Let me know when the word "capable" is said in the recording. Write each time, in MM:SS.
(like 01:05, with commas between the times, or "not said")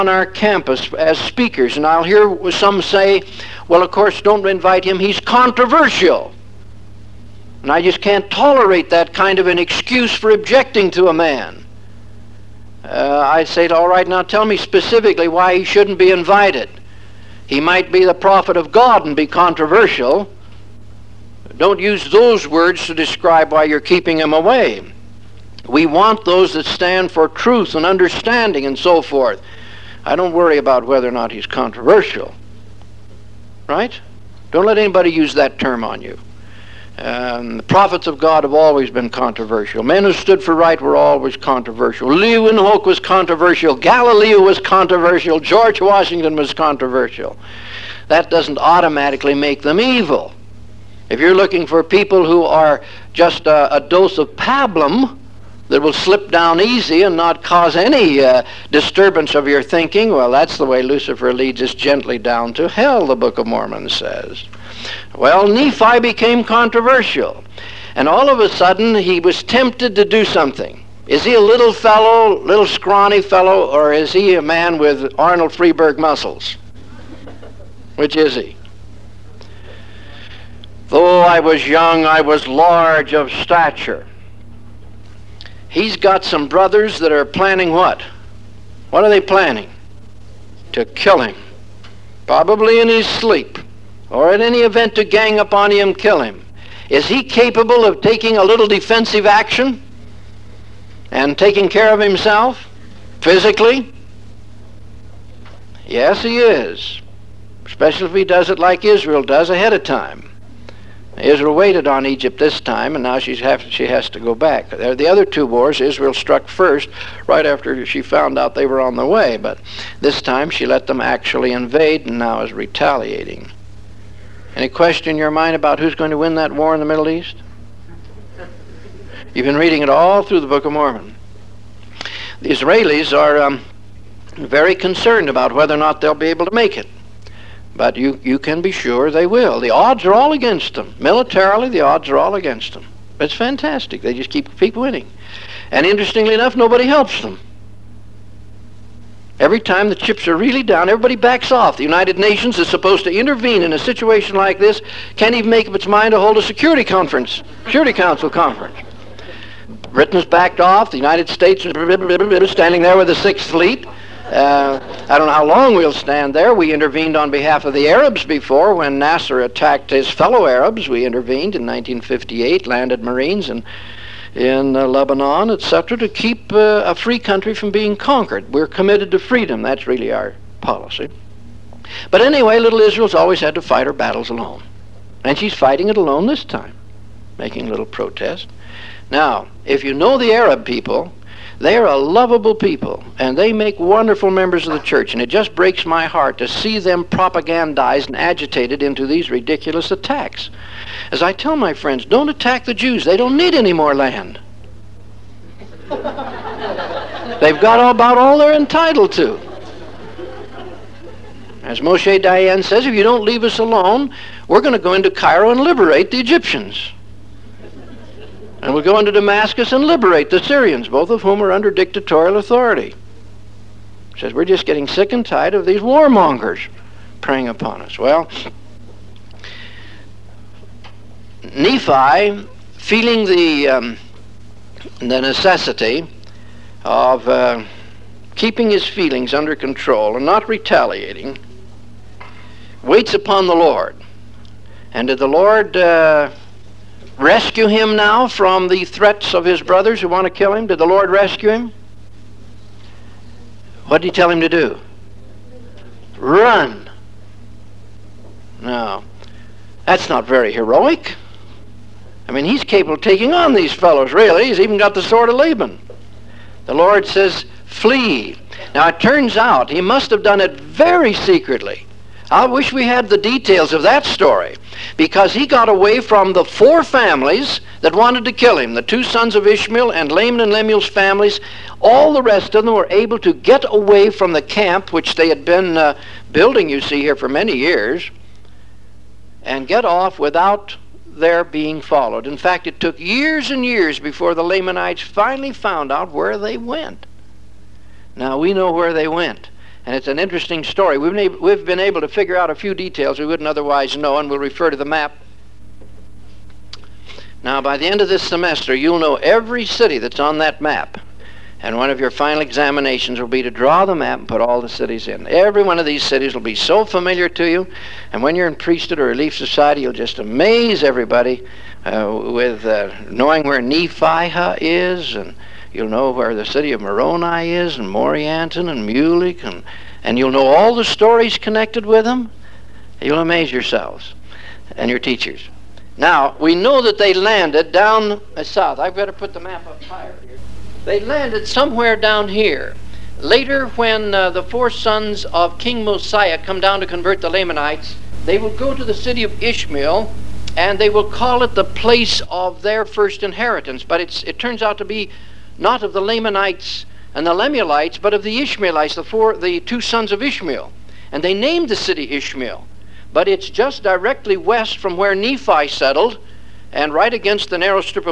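01:37, 04:22.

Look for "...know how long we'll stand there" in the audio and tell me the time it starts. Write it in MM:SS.
02:45.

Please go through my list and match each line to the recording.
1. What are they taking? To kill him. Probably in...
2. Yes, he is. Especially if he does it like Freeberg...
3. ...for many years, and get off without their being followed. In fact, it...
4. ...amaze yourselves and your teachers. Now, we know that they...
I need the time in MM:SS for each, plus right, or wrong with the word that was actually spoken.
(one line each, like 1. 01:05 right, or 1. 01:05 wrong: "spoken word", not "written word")
1. 01:28 wrong: "planning", not "taking"
2. 01:45 wrong: "Israel", not "Freeberg"
3. 04:47 right
4. 05:33 right.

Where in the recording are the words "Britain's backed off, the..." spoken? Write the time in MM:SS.
02:39.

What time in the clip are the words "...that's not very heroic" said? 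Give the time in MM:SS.
04:19.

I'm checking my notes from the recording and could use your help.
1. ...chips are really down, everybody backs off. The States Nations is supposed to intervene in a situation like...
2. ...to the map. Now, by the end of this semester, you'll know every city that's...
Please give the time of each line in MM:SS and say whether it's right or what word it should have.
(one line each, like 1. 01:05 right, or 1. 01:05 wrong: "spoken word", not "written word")
1. 02:29 wrong: "United", not "States"
2. 05:04 right.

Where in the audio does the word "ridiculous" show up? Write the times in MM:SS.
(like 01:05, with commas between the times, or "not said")
03:19.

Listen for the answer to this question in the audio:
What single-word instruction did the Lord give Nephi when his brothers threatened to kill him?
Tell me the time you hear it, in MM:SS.
04:27.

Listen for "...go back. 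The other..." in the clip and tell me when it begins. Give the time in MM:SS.
01:54.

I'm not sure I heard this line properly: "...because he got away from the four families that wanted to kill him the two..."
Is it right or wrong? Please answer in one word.
right.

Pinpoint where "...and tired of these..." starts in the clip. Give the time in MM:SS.
03:45.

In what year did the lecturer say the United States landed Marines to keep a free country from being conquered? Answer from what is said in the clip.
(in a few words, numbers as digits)
1958.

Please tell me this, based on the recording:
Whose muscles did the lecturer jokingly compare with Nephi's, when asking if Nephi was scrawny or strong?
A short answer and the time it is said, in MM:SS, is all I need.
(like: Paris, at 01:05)
Arnold Freeberg, at 01:15.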